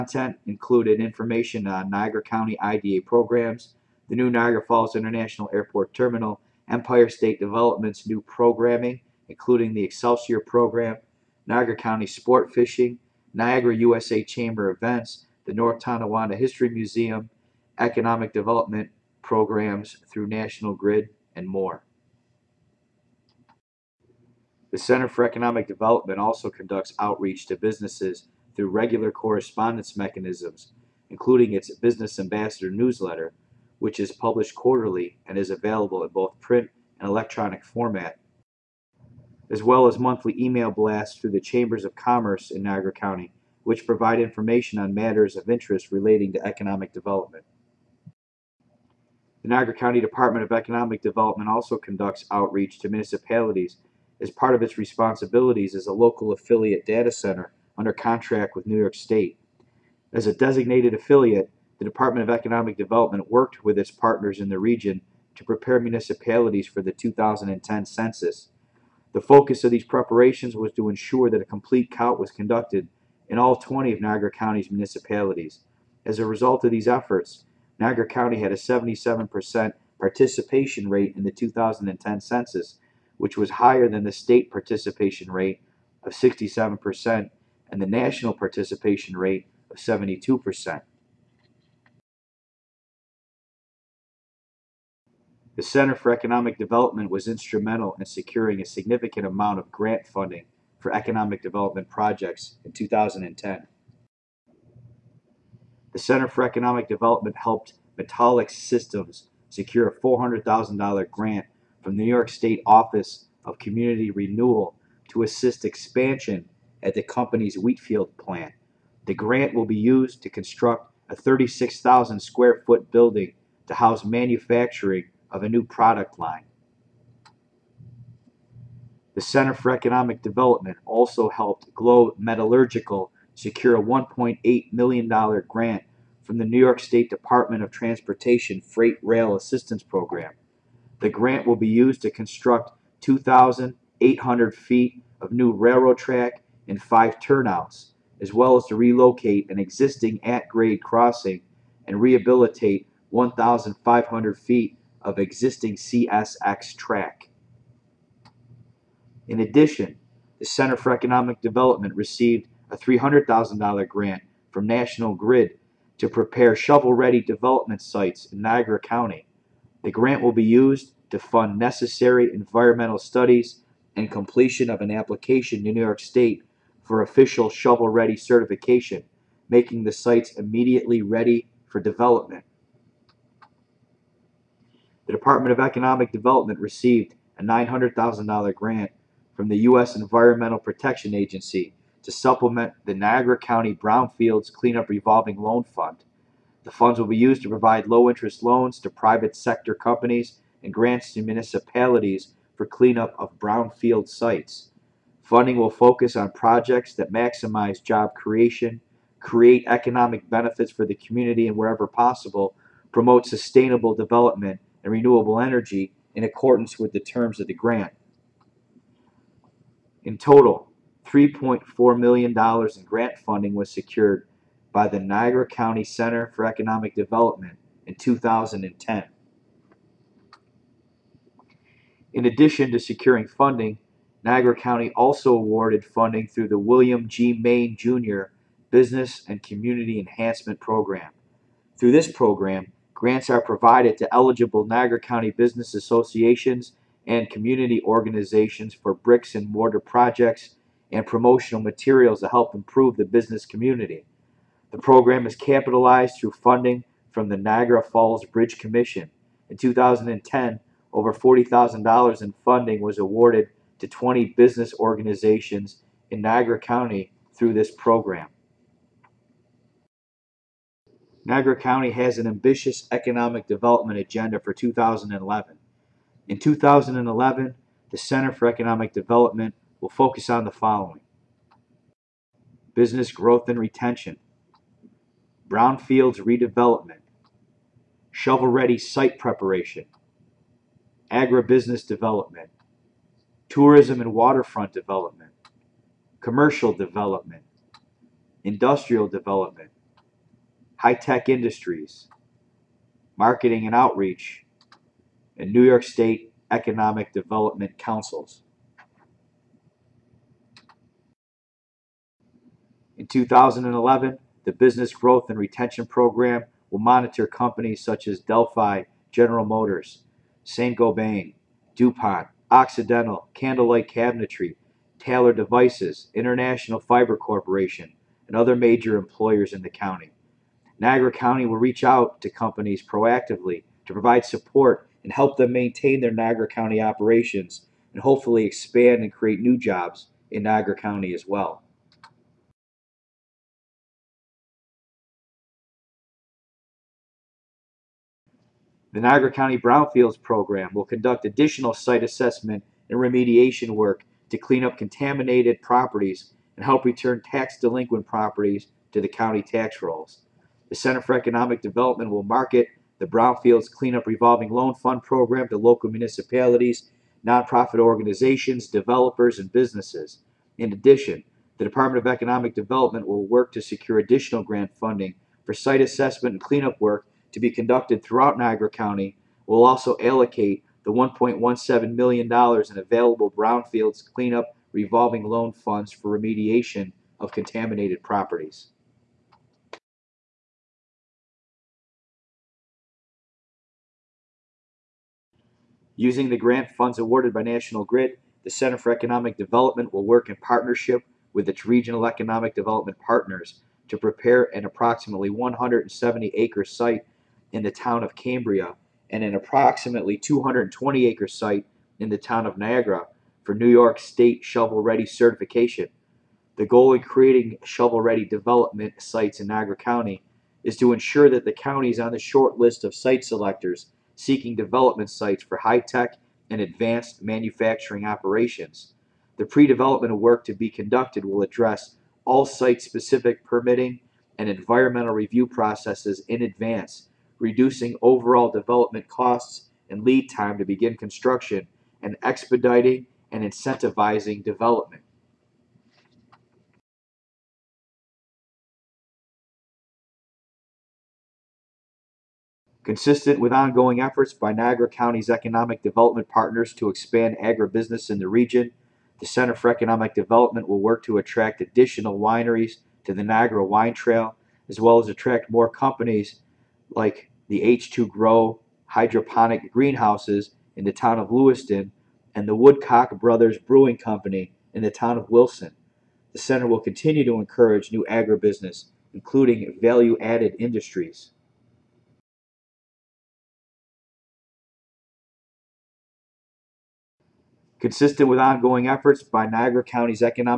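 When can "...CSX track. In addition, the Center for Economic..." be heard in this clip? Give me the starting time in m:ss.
2:35.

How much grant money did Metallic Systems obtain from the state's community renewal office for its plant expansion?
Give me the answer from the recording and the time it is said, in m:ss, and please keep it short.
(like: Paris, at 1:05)
$400,000, at 1:50.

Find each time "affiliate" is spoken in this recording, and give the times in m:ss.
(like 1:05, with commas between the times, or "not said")
0:56, 1:00.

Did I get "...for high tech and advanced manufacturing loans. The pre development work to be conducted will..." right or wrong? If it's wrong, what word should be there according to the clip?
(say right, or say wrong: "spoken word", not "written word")
wrong: "operations", not "loans".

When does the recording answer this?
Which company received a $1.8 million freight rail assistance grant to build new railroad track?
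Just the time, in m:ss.
2:11.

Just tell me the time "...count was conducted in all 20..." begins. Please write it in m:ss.
1:11.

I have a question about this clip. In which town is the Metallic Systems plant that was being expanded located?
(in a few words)
Wheatfield.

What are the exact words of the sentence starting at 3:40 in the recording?
In total, $3.4 million in grant funding was secured by the Niagara County Center for Economic Development in 2010.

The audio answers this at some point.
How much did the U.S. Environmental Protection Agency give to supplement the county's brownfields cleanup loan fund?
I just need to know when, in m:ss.
3:07.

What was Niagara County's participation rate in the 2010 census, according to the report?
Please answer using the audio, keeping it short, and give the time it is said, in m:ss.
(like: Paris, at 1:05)
77%, at 1:18.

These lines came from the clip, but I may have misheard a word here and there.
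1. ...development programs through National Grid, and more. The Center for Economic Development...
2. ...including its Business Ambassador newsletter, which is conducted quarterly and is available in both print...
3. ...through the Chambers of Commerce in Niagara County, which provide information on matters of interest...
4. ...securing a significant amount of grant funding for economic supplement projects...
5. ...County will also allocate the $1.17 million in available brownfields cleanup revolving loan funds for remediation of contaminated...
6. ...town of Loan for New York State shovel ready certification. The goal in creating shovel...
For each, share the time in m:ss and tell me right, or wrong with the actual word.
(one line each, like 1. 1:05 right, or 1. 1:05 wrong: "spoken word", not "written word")
1. 0:18 right
2. 0:31 wrong: "published", not "conducted"
3. 0:41 right
4. 1:38 wrong: "development", not "supplement"
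5. 6:18 right
6. 6:52 wrong: "Niagara", not "Loan".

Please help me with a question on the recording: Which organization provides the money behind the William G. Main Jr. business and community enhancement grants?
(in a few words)
Niagara Falls Bridge Commission.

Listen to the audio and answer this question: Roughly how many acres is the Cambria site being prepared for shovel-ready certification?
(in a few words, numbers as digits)
170 acres.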